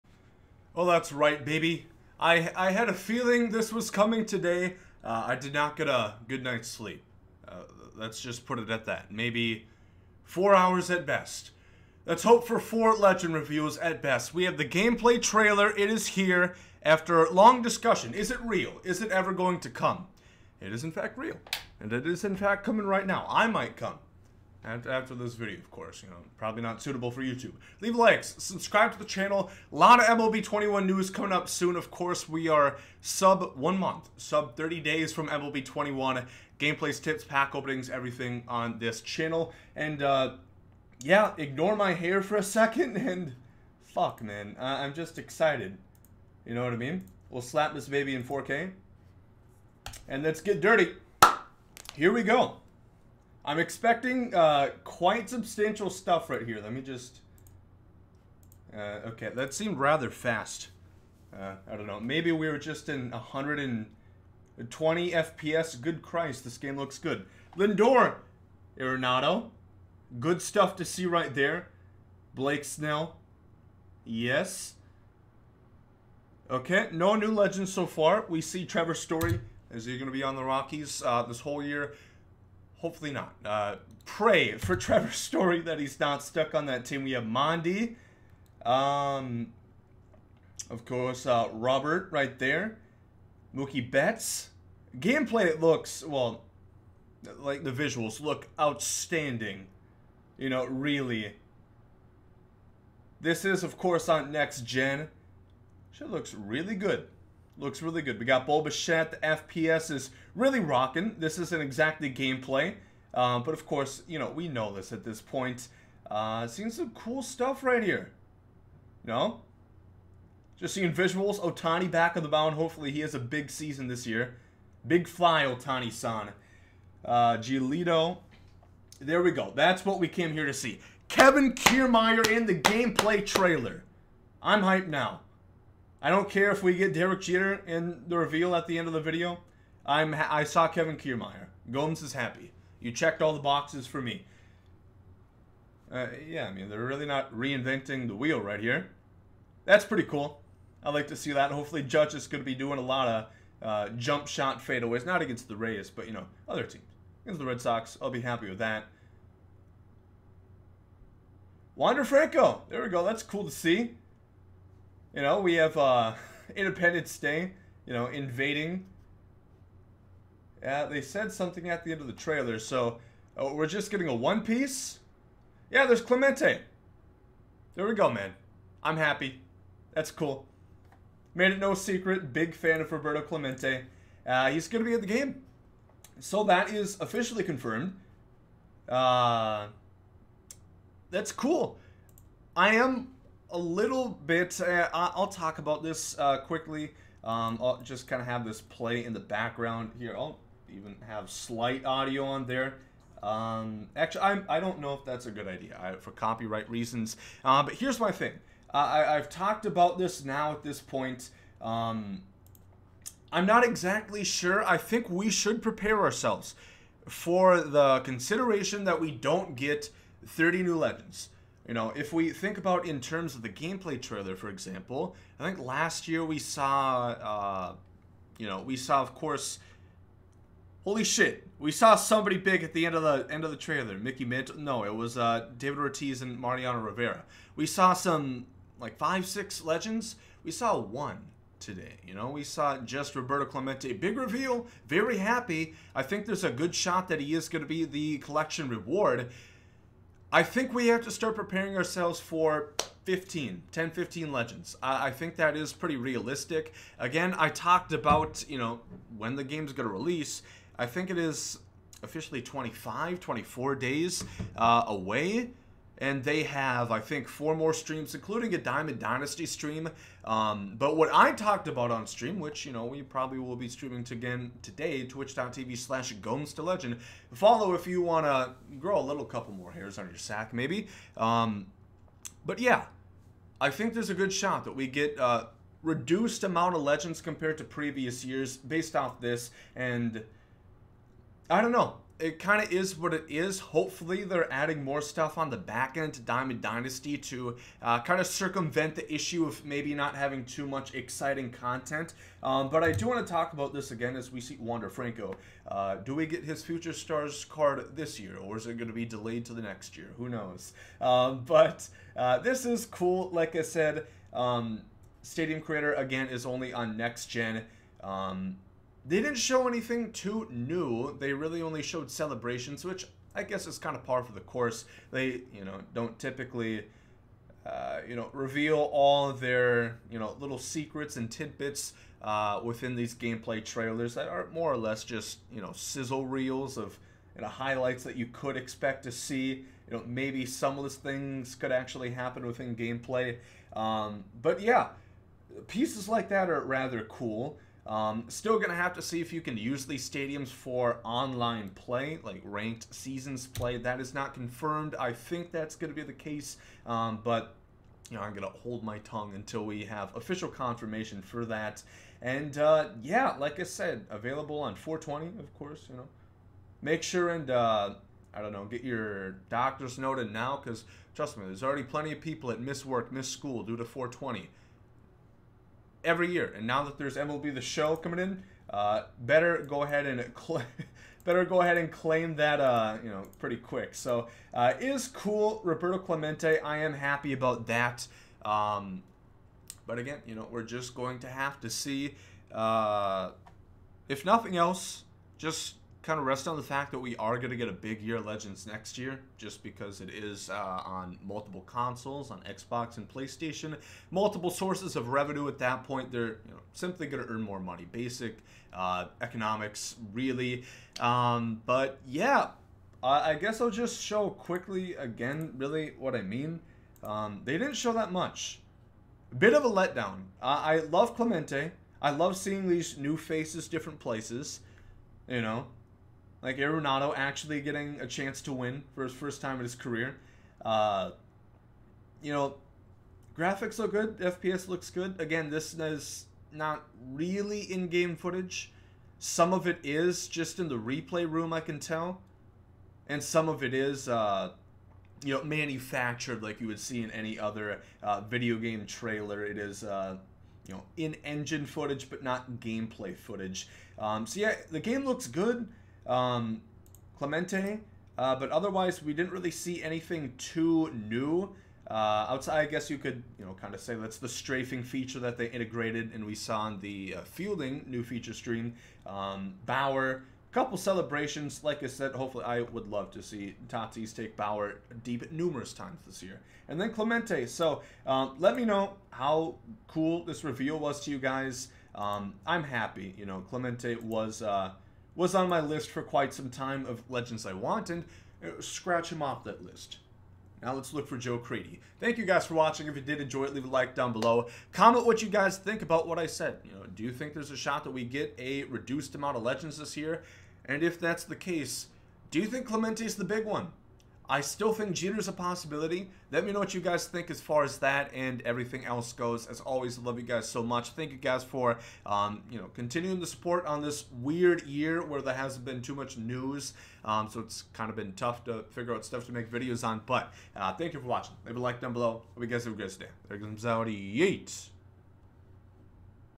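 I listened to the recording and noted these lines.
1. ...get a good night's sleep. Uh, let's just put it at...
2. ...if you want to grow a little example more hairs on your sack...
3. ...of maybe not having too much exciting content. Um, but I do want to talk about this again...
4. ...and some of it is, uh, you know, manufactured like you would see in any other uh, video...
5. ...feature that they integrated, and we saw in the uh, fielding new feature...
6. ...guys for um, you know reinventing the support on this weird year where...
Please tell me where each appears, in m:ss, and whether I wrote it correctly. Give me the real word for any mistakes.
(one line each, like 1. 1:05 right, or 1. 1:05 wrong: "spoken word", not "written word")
1. 0:05 right
2. 4:37 wrong: "couple", not "example"
3. 4:59 right
4. 7:23 right
5. 7:44 right
6. 8:31 wrong: "continuing", not "reinventing".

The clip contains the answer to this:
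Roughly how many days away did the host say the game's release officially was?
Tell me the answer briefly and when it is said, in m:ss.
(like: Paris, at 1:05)
24, at 4:23.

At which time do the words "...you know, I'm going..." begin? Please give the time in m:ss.
5:58.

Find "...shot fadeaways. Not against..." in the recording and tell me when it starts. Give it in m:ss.
2:34.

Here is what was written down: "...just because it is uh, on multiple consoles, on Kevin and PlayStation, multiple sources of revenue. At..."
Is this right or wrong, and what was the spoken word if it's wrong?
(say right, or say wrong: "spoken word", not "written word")
wrong: "Xbox", not "Kevin".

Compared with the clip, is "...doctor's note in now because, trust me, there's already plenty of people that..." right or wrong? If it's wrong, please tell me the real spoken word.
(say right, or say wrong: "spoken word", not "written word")
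right.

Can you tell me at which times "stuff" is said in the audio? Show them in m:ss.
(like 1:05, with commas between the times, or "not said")
0:55, 1:10, 1:57, 4:55, 8:39.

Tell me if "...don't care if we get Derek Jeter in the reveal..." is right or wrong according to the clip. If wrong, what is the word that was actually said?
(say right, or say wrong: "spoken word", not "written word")
right.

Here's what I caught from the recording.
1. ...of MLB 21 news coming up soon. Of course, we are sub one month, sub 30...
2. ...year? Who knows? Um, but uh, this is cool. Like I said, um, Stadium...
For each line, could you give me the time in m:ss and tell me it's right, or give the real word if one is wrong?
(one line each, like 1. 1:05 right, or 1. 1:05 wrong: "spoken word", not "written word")
1. 0:29 right
2. 5:09 right.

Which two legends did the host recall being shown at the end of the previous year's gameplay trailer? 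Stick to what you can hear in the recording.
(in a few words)
David Ortiz and Mariano Rivera.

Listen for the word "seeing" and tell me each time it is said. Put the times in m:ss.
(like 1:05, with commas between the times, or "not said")
1:56, 2:00, 7:02.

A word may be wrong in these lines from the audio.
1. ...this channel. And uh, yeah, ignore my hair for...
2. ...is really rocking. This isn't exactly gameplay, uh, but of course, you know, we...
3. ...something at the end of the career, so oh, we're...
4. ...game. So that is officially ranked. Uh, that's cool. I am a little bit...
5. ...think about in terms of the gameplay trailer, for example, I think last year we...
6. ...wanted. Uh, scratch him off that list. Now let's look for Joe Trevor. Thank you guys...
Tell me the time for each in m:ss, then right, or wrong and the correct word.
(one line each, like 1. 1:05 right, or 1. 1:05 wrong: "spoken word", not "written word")
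1. 0:38 right
2. 1:49 right
3. 2:51 wrong: "trailer", not "career"
4. 3:05 wrong: "confirmed", not "ranked"
5. 3:42 right
6. 8:07 wrong: "Creedy", not "Trevor".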